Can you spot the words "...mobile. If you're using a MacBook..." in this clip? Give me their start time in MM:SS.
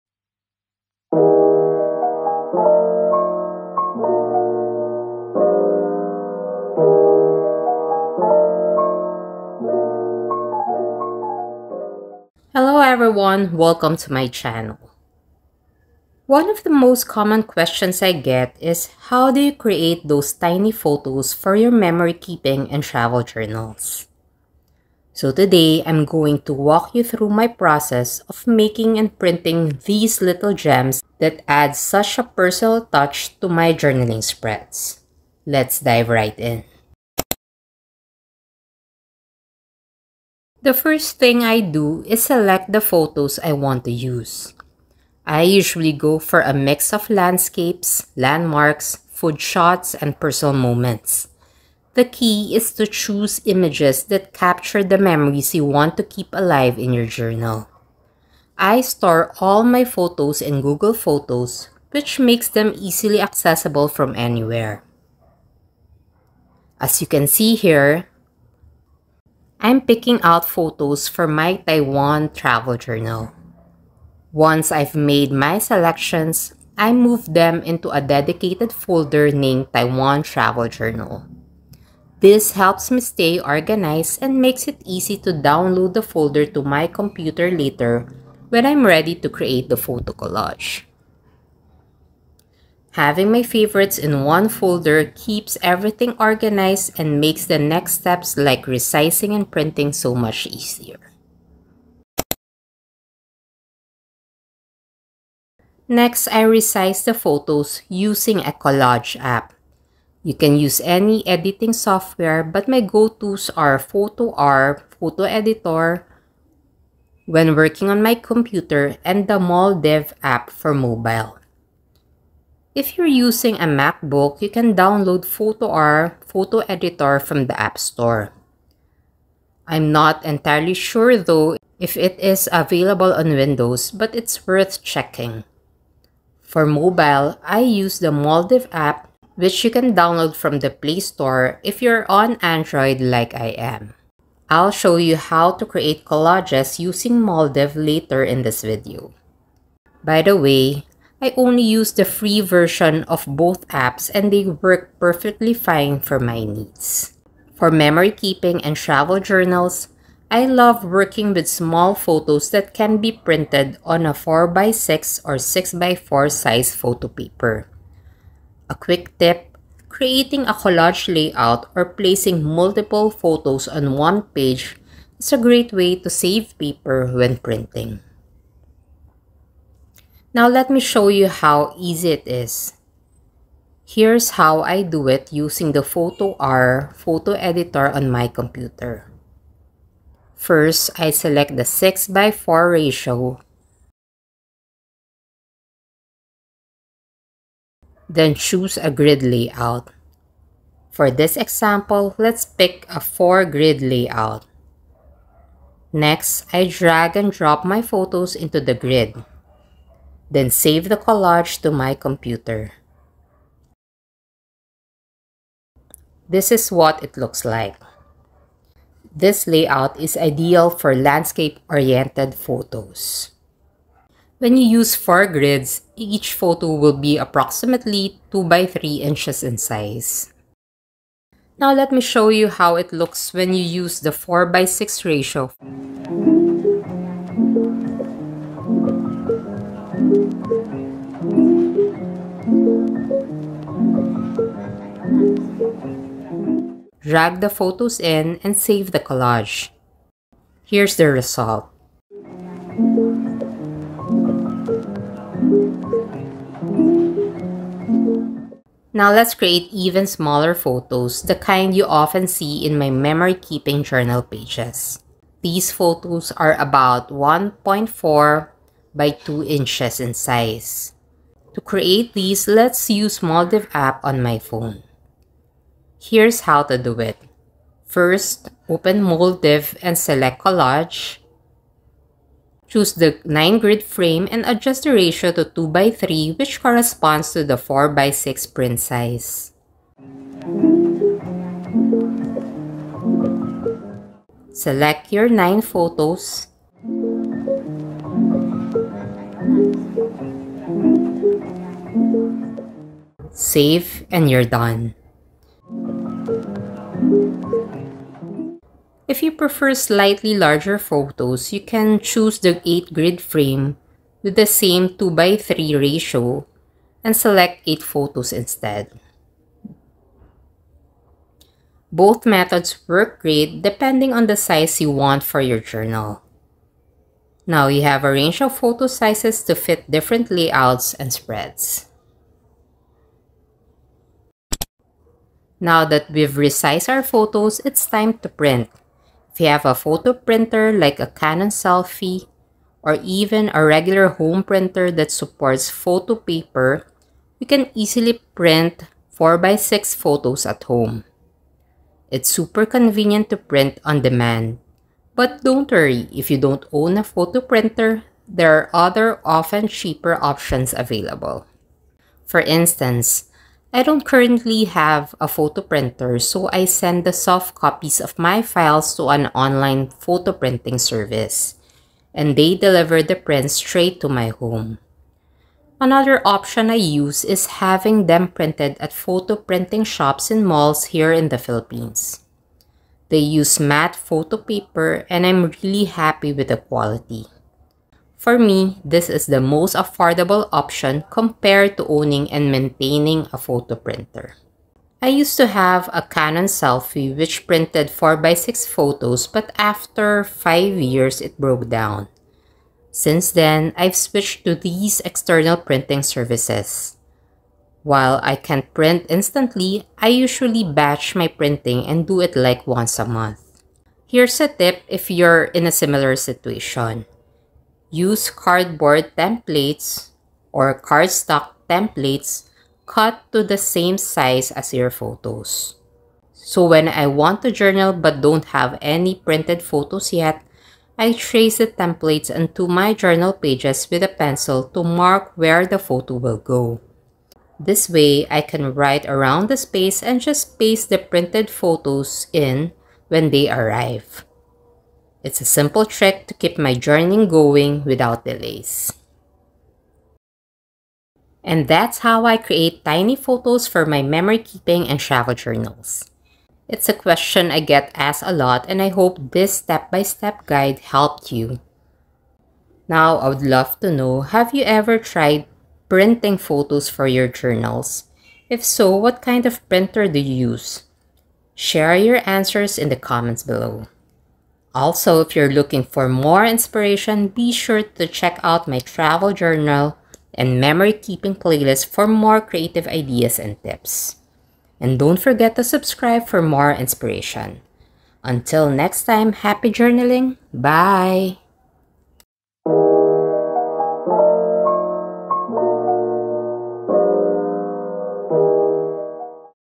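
02:00.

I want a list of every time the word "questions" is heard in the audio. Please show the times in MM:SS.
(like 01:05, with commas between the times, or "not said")
00:17, 07:36.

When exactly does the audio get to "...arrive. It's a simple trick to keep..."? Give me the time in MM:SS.
07:23.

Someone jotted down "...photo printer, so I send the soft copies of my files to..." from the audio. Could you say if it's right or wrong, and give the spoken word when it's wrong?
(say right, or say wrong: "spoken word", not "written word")
right.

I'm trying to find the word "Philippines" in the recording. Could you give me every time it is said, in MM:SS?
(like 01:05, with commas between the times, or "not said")
06:21.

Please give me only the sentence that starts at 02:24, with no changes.
I'll show you how to create collages using Moldiv later in this video.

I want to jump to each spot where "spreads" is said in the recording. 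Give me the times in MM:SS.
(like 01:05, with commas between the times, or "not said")
00:34, 05:31.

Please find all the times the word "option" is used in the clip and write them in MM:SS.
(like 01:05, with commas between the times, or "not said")
06:00, 06:16, 06:30.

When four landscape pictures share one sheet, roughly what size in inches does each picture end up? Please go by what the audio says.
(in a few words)
2 by 3 inches.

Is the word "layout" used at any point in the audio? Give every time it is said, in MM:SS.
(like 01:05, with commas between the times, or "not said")
02:51, 03:19, 03:23, 03:39, 05:30.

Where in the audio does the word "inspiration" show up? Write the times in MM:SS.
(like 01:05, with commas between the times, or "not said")
07:56, 08:06.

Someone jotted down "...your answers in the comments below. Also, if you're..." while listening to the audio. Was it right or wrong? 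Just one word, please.
right.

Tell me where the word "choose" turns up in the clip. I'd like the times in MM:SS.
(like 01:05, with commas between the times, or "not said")
00:52, 03:18, 04:42, 05:11.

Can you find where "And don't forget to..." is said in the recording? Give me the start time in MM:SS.
08:04.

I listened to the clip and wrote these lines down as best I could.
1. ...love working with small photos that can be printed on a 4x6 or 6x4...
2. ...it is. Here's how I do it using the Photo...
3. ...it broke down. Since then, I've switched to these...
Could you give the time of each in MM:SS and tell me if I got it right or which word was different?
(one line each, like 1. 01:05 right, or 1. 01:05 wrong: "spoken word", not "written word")
1. 02:40 right
2. 03:02 wrong: "Fotor", not "Photo"
3. 06:41 right.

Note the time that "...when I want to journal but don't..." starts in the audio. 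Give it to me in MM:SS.
07:06.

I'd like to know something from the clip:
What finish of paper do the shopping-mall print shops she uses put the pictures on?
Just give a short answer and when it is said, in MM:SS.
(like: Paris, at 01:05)
matte, at 06:23.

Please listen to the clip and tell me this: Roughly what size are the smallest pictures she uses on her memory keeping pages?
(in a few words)
1.4 by 2 inches.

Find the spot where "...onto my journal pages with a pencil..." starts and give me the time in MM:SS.
07:12.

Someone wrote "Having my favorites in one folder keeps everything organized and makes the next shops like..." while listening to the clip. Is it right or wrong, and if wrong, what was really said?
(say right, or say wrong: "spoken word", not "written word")
wrong: "steps", not "shops".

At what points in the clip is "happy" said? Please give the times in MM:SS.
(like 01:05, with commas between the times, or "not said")
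06:25, 08:09.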